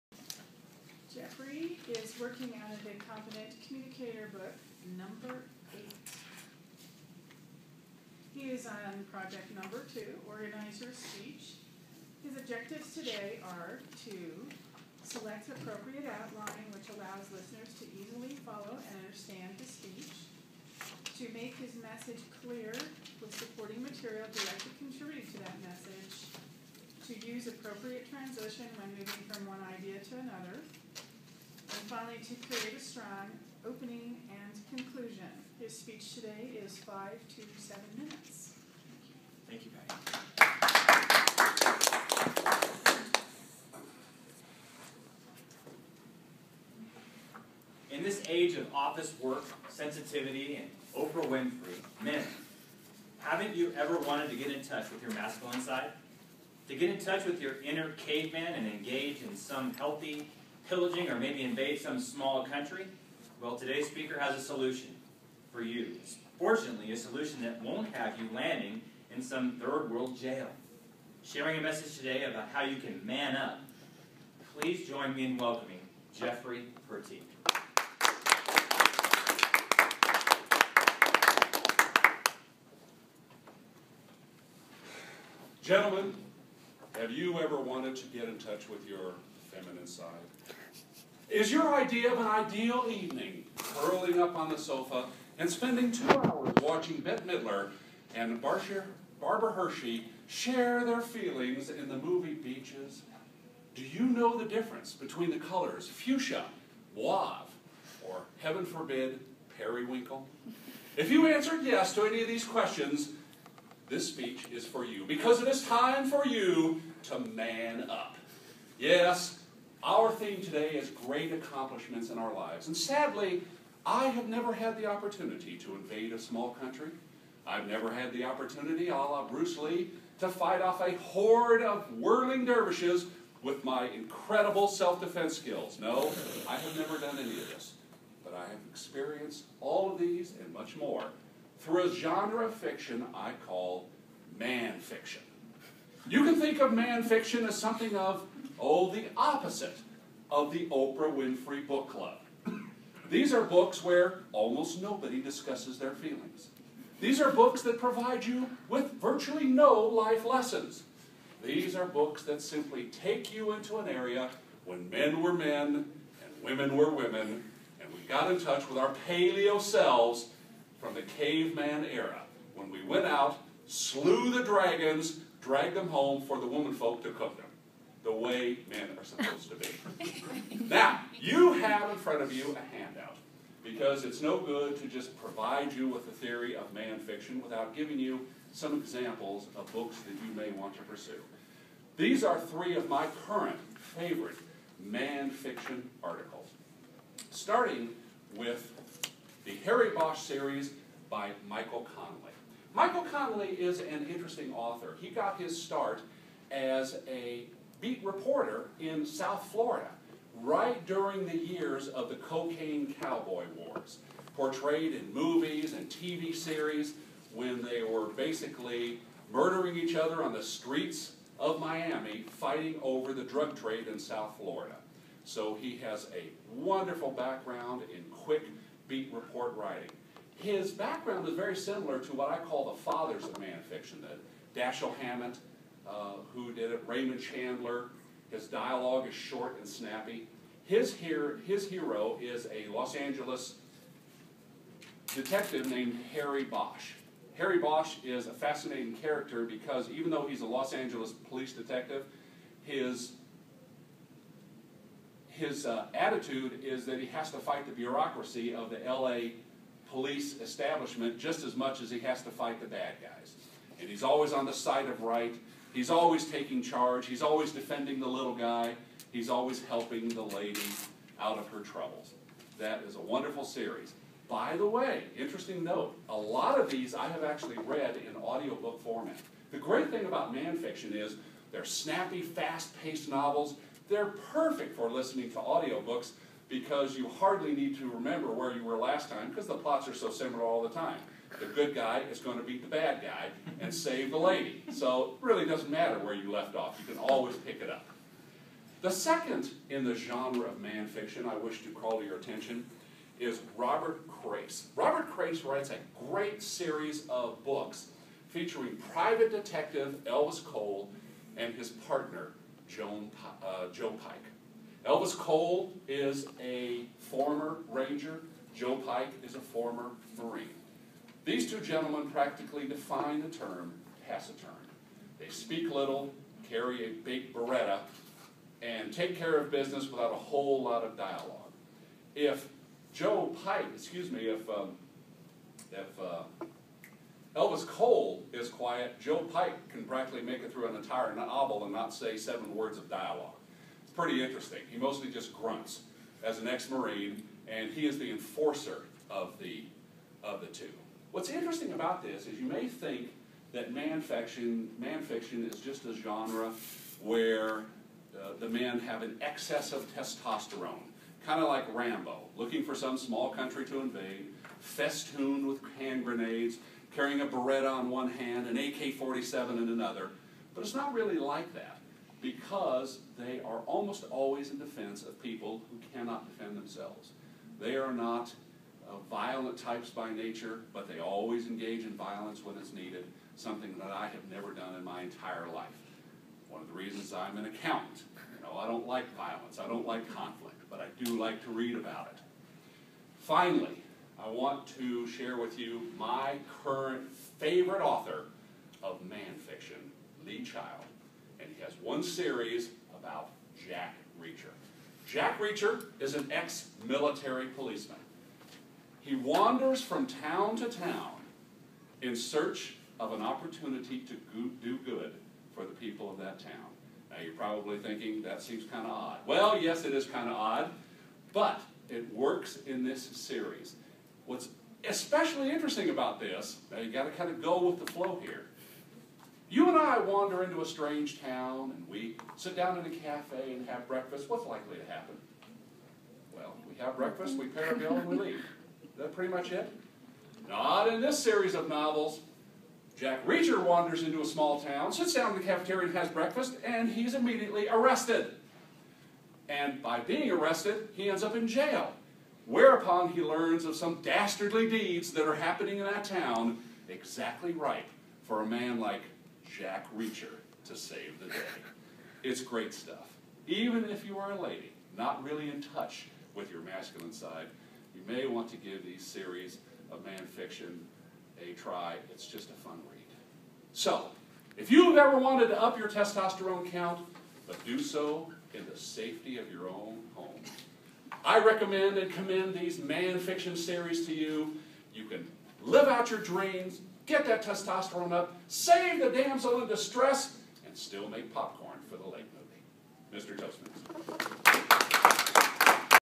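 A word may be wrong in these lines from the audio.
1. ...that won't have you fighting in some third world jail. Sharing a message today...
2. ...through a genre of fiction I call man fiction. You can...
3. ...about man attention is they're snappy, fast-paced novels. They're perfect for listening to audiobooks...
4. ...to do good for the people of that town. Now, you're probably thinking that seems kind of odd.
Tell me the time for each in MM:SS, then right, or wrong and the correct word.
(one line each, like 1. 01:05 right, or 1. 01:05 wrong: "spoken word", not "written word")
1. 01:07 wrong: "landing", not "fighting"
2. 02:21 right
3. 04:40 wrong: "fiction", not "attention"
4. 06:53 right.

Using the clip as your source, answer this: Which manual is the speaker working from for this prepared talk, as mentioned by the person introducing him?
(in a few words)
Competent Communicator.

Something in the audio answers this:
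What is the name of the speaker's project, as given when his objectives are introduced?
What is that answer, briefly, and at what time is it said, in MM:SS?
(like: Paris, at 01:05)
Organizer Speech, at 00:10.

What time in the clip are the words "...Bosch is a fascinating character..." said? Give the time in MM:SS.
04:07.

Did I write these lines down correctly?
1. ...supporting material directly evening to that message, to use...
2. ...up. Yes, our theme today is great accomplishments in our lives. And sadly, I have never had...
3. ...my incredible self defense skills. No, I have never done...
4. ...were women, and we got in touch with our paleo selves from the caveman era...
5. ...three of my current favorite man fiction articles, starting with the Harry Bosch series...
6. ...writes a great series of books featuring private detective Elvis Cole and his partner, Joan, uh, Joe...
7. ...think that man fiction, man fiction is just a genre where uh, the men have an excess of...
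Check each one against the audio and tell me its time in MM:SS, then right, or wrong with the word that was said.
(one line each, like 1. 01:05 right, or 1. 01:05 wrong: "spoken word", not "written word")
1. 00:23 wrong: "contributing", not "evening"
2. 01:57 right
3. 02:13 right
4. 02:46 right
5. 03:12 right
6. 05:05 right
7. 05:52 right.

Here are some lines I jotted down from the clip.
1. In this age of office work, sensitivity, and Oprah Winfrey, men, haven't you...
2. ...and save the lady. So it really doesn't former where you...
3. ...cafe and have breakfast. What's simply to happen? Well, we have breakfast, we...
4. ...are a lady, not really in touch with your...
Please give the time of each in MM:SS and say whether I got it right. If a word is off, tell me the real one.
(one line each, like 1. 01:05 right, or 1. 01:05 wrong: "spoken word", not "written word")
1. 00:47 right
2. 04:53 wrong: "matter", not "former"
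3. 07:12 wrong: "likely", not "simply"
4. 07:44 right.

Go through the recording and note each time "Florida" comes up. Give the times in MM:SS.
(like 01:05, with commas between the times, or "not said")
03:29, 03:44.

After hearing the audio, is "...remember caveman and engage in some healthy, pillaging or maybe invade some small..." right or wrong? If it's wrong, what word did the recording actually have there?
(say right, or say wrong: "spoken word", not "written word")
wrong: "inner", not "remember".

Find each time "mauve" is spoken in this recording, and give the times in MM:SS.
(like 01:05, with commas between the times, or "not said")
01:46.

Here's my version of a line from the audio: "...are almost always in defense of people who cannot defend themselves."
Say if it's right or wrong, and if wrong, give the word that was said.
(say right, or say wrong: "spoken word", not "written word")
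right.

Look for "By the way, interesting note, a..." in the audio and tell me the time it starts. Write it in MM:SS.
04:34.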